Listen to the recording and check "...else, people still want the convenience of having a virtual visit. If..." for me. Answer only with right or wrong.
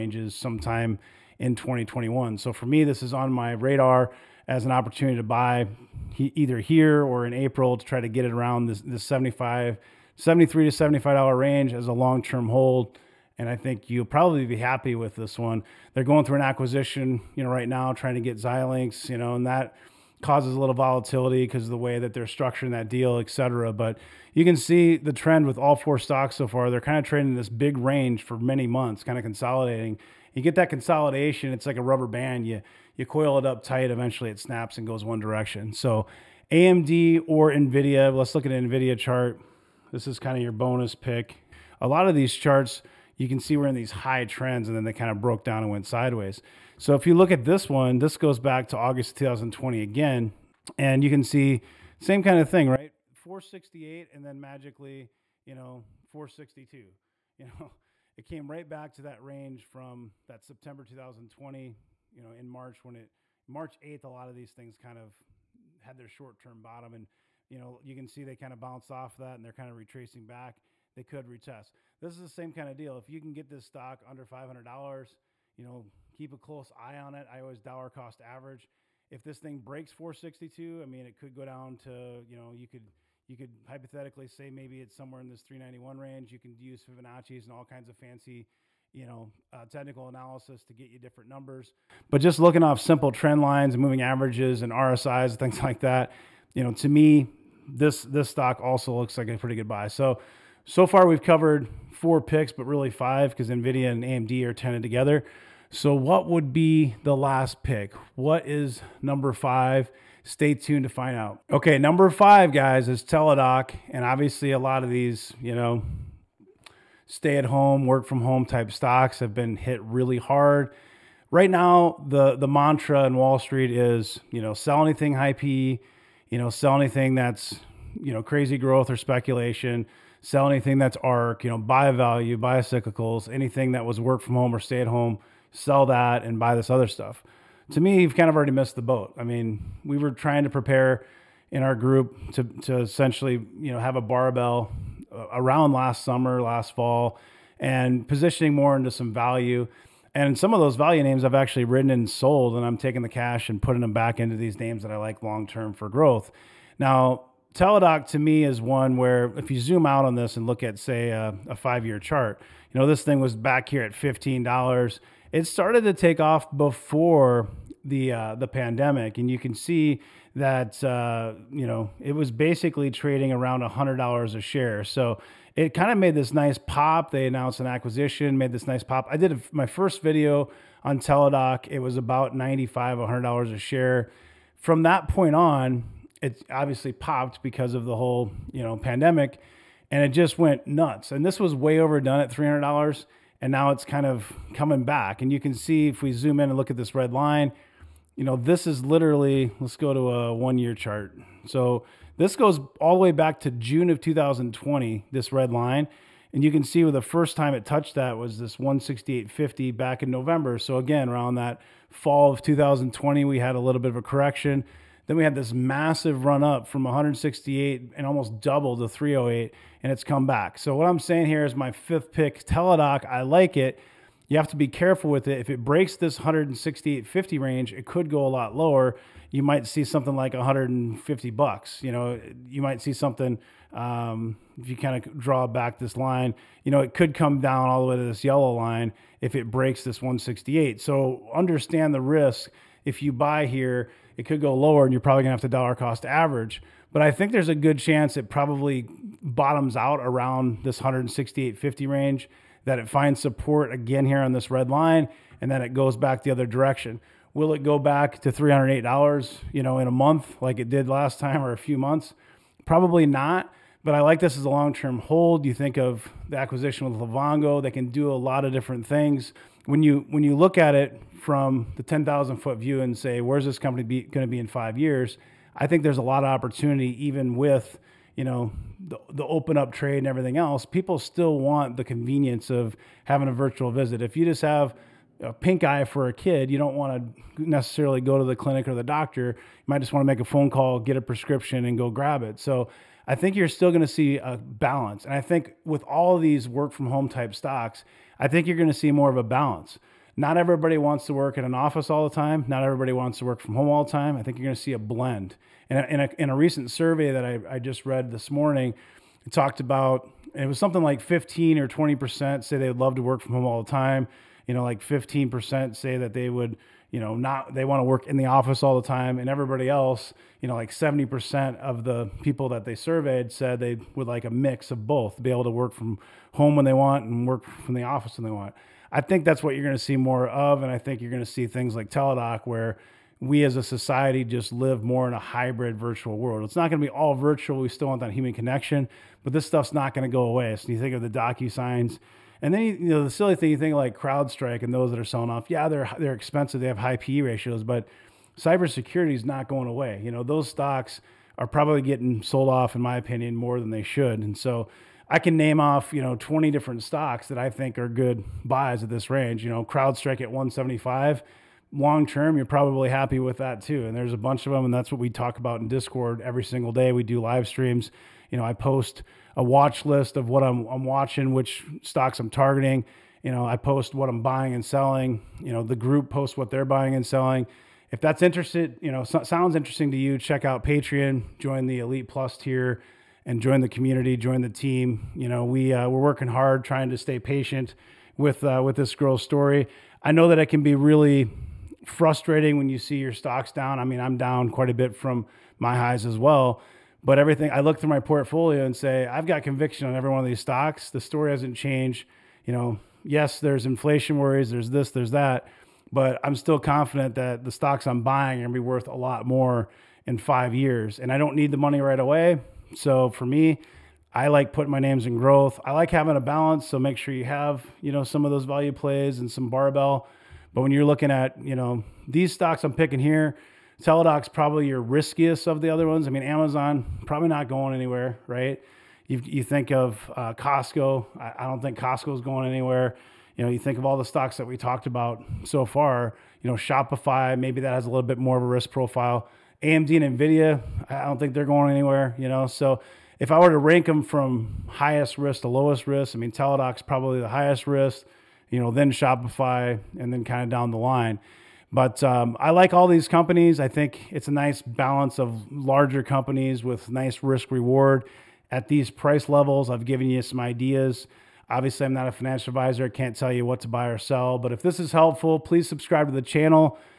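right.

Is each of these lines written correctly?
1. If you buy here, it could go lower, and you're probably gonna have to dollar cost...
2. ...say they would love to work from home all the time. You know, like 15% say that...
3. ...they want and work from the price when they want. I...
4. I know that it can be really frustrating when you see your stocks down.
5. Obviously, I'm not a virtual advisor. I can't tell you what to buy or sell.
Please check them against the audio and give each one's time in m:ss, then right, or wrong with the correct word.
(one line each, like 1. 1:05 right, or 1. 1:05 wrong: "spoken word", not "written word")
1. 4:02 right
2. 5:12 right
3. 5:26 wrong: "office", not "price"
4. 6:30 right
5. 7:41 wrong: "financial", not "virtual".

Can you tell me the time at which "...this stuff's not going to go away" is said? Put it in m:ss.
5:39.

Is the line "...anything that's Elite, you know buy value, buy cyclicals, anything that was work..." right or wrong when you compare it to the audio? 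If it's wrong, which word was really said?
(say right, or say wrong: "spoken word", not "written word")
wrong: "ARK", not "Elite".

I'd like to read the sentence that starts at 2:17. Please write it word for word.
To me, you've kind of already missed the boat.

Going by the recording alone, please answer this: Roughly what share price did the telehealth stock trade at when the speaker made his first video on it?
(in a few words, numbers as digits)
$95.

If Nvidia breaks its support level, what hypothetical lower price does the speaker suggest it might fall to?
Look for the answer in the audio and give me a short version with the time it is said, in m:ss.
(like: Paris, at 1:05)
$391, at 1:25.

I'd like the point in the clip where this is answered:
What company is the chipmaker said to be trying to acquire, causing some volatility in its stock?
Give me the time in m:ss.
0:18.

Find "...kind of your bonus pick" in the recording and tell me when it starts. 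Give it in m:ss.
0:40.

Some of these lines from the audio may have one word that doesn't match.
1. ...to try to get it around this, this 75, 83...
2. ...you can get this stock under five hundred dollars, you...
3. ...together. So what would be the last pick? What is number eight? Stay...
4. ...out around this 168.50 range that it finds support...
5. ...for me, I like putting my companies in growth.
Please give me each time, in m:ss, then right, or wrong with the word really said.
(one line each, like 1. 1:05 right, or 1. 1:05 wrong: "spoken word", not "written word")
1. 0:07 wrong: "73", not "83"
2. 1:13 right
3. 1:44 wrong: "five", not "eight"
4. 4:09 right
5. 6:53 wrong: "names", not "companies".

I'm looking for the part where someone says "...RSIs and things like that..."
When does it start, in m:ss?
1:34.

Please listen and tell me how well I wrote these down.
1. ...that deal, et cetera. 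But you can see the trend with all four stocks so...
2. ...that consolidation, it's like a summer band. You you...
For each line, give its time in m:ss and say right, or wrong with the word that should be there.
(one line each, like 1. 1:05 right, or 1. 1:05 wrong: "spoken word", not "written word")
1. 0:22 right
2. 0:30 wrong: "rubber", not "summer".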